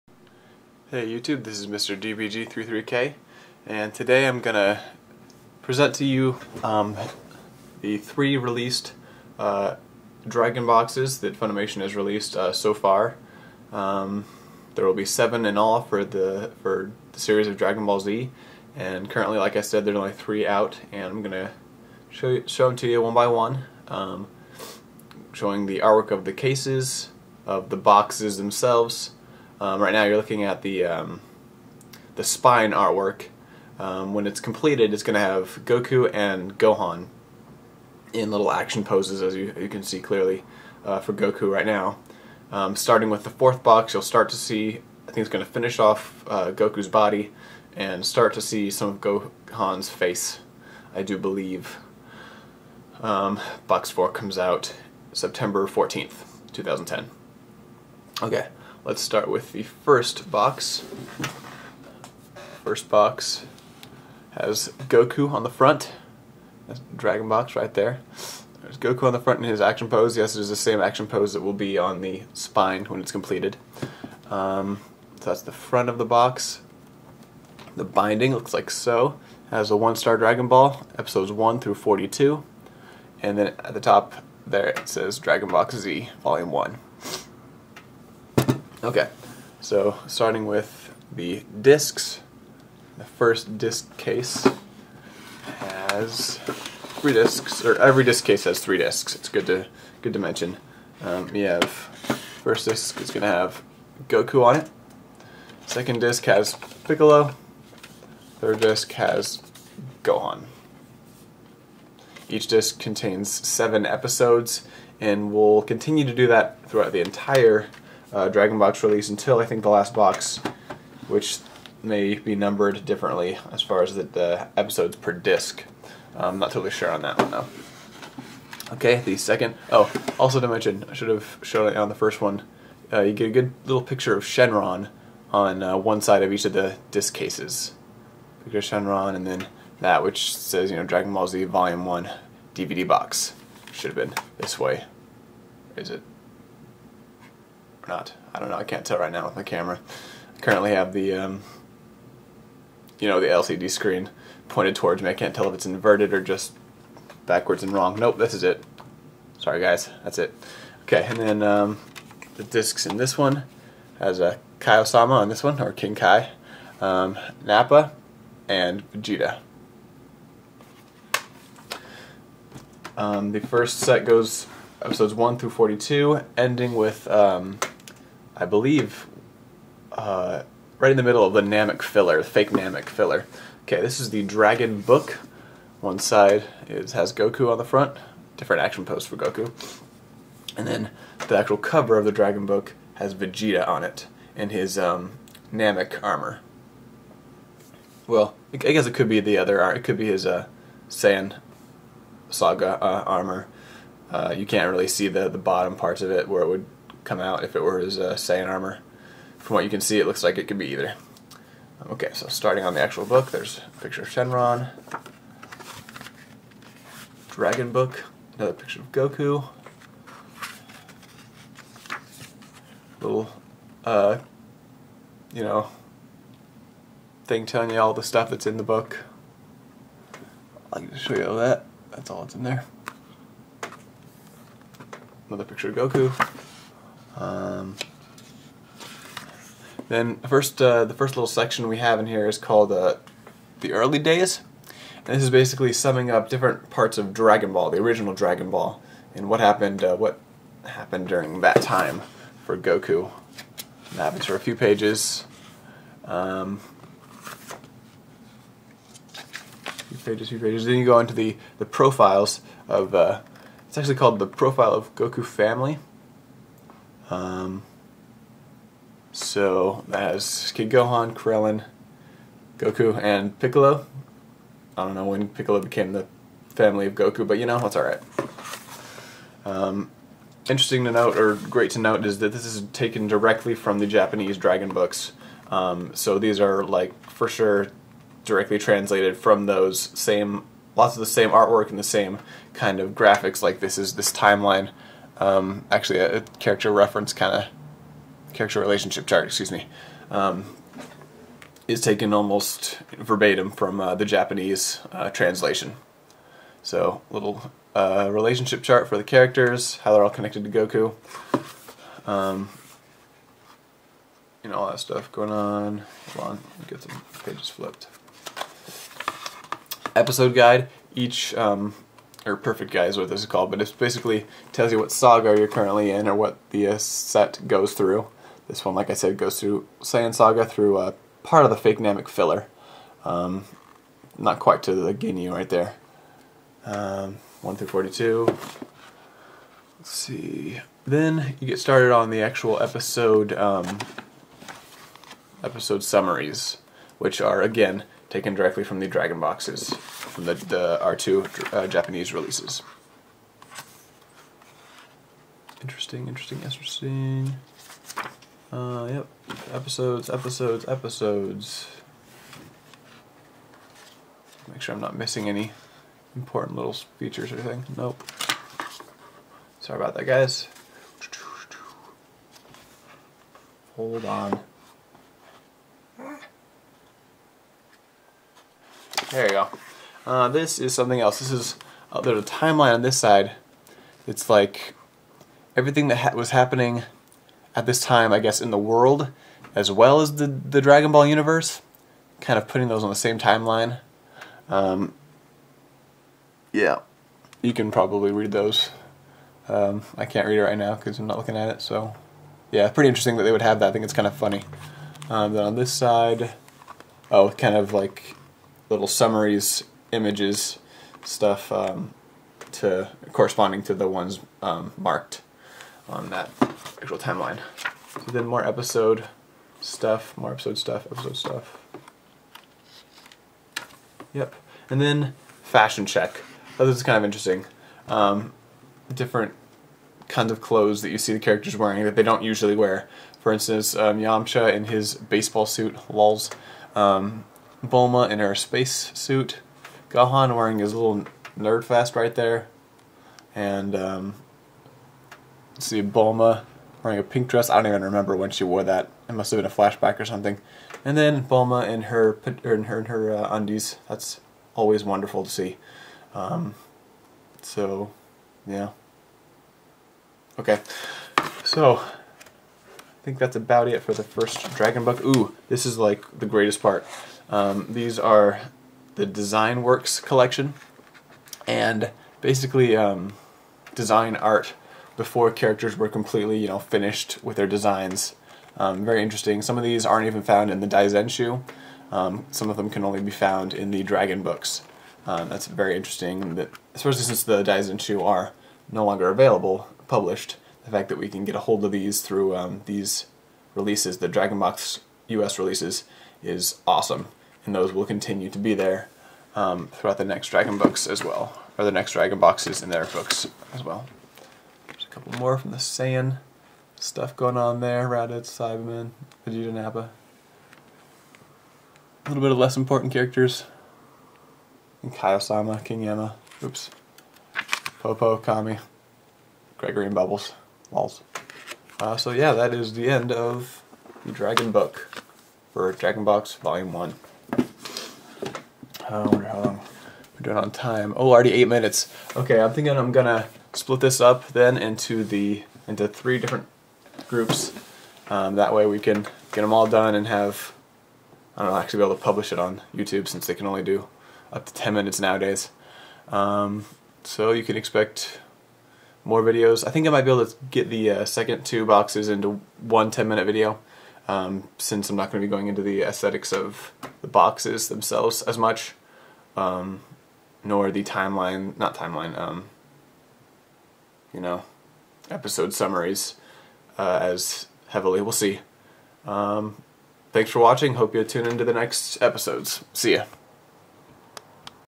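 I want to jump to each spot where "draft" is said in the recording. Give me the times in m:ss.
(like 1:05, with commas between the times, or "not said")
not said.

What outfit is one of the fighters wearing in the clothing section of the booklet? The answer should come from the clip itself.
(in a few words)
baseball suit.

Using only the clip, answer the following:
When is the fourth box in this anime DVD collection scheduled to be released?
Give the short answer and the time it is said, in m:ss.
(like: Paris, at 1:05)
September 14th, 2010, at 0:55.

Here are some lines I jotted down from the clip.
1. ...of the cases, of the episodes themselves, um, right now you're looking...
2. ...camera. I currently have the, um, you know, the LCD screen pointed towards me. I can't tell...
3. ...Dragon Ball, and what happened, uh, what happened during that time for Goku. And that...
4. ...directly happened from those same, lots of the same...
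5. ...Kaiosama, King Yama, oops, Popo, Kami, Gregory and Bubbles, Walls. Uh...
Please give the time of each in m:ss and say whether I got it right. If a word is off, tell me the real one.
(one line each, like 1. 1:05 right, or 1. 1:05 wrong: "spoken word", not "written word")
1. 0:26 wrong: "boxes", not "episodes"
2. 2:29 right
3. 4:08 right
4. 4:48 wrong: "translated", not "happened"
5. 8:34 right.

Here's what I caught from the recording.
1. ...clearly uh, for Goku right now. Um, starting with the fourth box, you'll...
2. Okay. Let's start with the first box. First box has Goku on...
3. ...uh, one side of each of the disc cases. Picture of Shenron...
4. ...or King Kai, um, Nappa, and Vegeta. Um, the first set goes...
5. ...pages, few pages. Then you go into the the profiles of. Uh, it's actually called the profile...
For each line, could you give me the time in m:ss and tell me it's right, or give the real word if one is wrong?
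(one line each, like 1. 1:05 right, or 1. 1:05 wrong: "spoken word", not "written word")
1. 0:40 right
2. 0:58 right
3. 2:15 right
4. 2:45 right
5. 4:20 right.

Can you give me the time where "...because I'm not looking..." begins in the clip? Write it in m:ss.
6:40.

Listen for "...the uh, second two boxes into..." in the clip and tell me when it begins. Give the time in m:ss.
9:10.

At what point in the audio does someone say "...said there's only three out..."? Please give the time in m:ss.
0:19.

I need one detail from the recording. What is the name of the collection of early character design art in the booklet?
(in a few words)
Design Works collection.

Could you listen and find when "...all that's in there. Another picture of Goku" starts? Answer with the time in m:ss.
3:52.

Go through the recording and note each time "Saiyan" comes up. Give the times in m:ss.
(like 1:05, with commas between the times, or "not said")
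3:20, 3:28, 5:29, 8:25.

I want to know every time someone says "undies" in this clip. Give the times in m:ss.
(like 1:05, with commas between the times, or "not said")
7:33.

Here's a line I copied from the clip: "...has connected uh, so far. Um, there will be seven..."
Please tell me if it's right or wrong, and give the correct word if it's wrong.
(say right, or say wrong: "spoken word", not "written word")
wrong: "released", not "connected".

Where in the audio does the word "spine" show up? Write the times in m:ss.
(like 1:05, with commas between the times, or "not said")
0:32, 1:12.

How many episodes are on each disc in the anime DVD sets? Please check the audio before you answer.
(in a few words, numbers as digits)
7.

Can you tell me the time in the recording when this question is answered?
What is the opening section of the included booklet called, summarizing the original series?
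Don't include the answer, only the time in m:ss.
4:03.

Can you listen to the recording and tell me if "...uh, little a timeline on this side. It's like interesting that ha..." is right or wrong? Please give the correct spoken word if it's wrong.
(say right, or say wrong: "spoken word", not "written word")
wrong: "everything", not "interesting".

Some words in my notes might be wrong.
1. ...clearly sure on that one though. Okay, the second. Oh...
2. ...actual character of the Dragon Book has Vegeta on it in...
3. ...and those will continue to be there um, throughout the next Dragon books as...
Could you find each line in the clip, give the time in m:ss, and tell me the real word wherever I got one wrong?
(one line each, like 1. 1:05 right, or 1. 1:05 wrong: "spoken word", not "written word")
1. 2:06 wrong: "totally", not "clearly"
2. 3:11 wrong: "cover", not "character"
3. 8:17 right.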